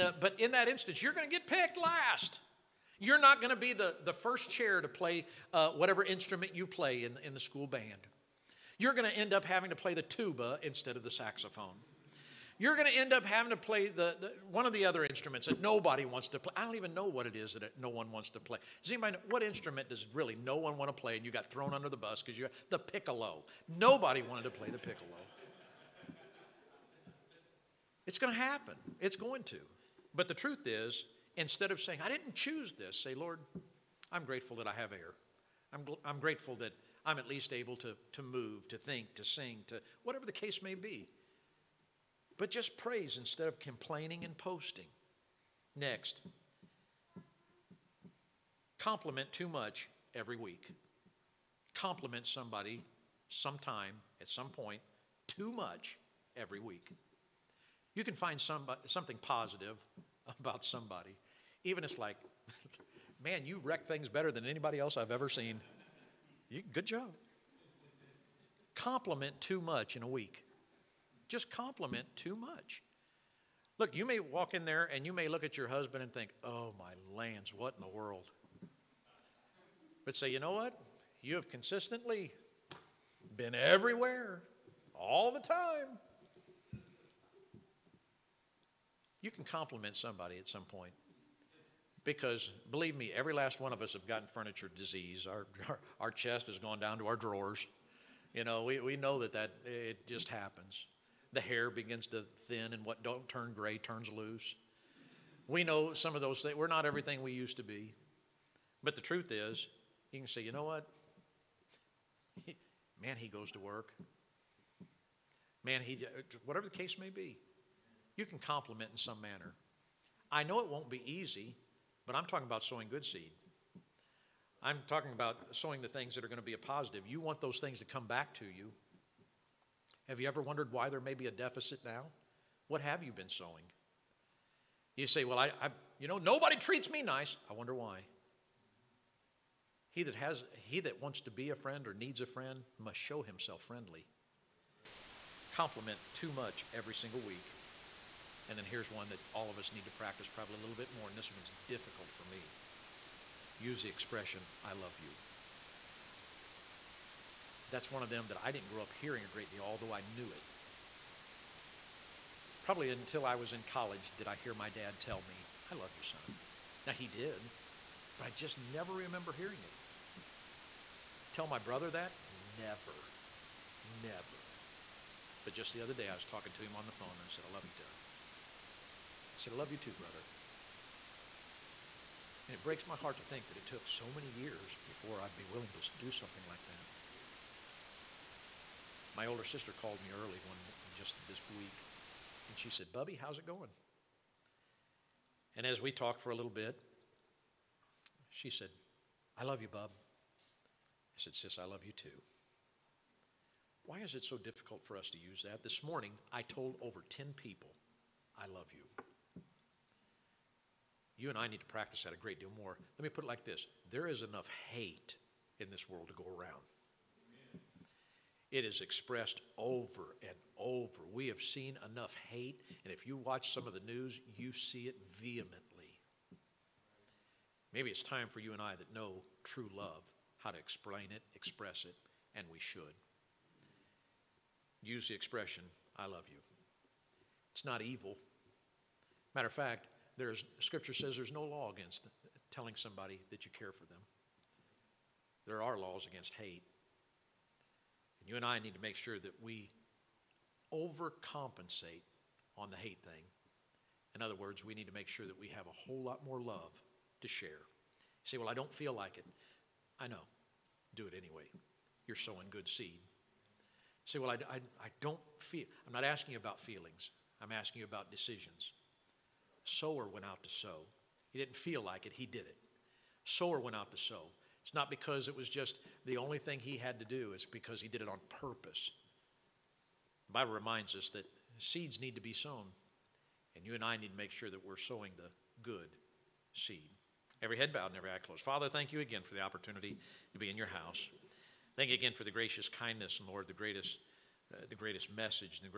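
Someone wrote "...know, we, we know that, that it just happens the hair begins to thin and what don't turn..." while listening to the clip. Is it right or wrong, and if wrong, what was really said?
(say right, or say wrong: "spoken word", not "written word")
right.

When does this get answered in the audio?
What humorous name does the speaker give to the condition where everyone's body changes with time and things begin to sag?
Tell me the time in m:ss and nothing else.
1:34.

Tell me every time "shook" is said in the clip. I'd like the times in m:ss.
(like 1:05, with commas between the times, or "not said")
not said.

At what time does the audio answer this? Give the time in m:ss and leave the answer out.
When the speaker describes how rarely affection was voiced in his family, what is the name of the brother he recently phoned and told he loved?
2:57.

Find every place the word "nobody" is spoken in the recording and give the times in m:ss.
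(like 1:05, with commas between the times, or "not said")
0:15, 0:23, 2:16.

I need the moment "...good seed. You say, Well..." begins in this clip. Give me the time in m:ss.
4:22.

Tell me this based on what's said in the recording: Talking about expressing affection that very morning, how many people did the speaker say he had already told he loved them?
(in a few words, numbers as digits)
over 10.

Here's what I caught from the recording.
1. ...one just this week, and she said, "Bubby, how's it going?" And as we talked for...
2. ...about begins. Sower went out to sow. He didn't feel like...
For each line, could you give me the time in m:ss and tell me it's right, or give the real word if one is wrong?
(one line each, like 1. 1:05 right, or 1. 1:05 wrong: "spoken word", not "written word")
1. 3:10 right
2. 4:27 wrong: "decisions", not "begins".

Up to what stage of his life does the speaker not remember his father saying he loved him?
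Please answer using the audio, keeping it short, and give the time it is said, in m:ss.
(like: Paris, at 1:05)
college, at 2:43.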